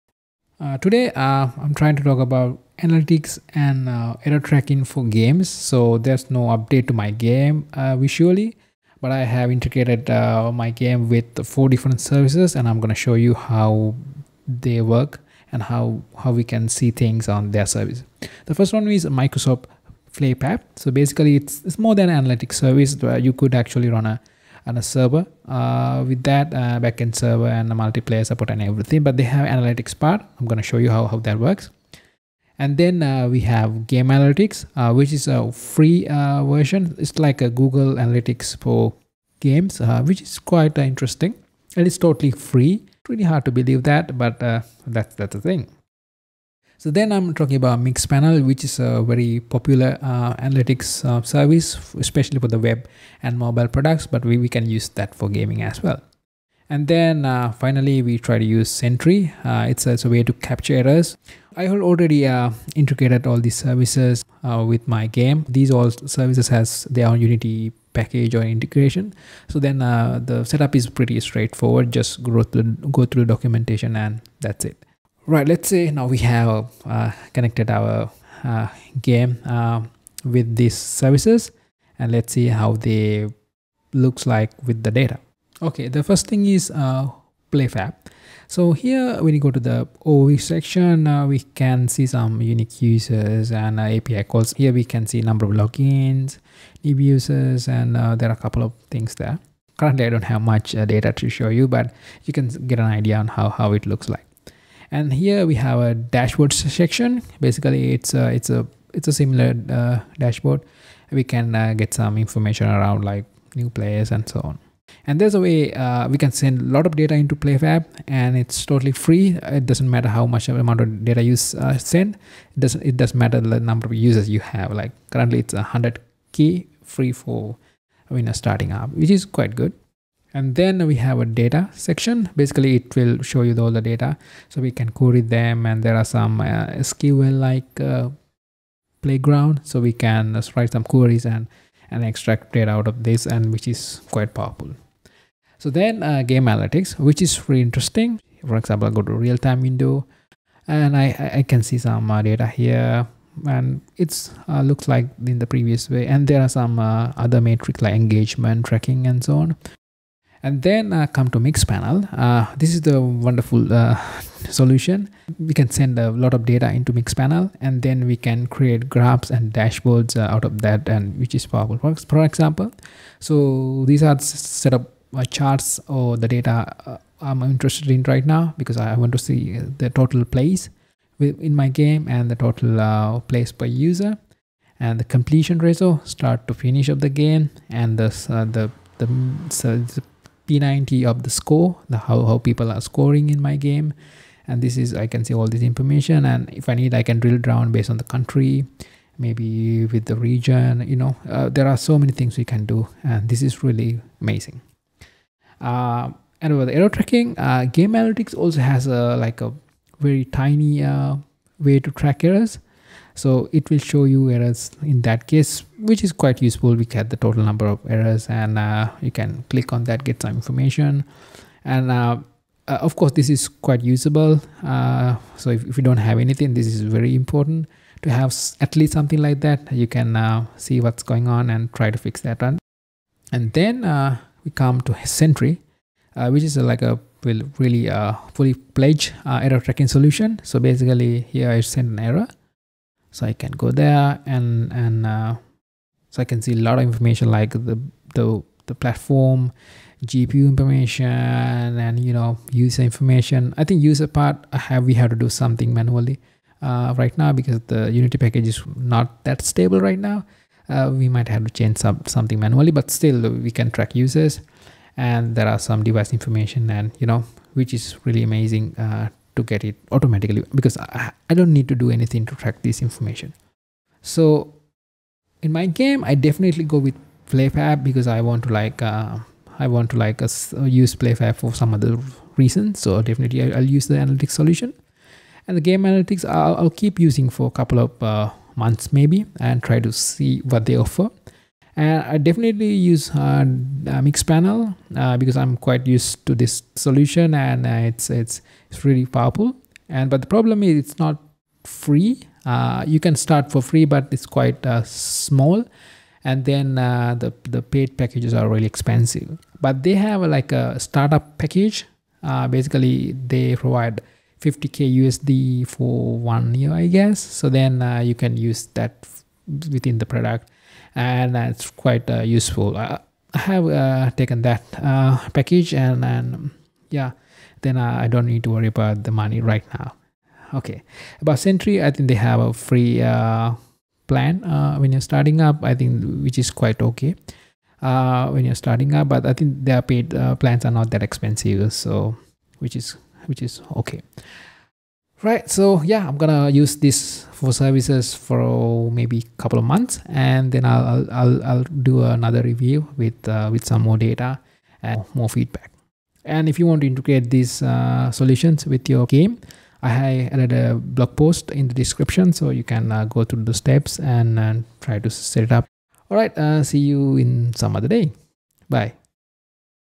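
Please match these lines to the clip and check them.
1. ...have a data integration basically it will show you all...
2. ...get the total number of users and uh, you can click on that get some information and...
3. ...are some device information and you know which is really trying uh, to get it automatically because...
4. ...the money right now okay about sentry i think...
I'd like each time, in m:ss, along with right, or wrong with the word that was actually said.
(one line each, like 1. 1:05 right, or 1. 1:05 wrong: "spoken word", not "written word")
1. 2:10 wrong: "section", not "integration"
2. 3:36 wrong: "errors", not "users"
3. 4:25 wrong: "amazing", not "trying"
4. 5:29 right.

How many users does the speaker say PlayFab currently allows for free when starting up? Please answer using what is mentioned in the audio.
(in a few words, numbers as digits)
100k.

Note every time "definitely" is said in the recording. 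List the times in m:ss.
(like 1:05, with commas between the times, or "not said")
4:36, 4:43, 4:52.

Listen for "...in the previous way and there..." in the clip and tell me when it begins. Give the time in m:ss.
2:35.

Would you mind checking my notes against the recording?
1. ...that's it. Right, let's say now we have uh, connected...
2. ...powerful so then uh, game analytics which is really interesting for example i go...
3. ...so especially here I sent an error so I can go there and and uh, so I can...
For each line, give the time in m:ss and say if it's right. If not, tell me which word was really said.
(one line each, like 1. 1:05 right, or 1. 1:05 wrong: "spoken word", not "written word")
1. 1:14 right
2. 2:24 right
3. 4:00 wrong: "basically", not "especially".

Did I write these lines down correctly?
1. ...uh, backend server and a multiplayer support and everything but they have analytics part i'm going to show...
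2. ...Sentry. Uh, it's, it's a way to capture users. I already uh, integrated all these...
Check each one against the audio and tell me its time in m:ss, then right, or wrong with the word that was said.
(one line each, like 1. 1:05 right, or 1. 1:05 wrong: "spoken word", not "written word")
1. 0:26 right
2. 0:58 wrong: "errors", not "users".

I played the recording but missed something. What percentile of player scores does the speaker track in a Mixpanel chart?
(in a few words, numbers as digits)
P90.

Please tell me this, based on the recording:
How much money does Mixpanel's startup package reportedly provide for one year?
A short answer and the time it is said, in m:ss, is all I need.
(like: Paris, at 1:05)
50k USD, at 5:14.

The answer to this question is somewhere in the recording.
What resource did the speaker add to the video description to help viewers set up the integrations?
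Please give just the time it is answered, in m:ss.
6:00.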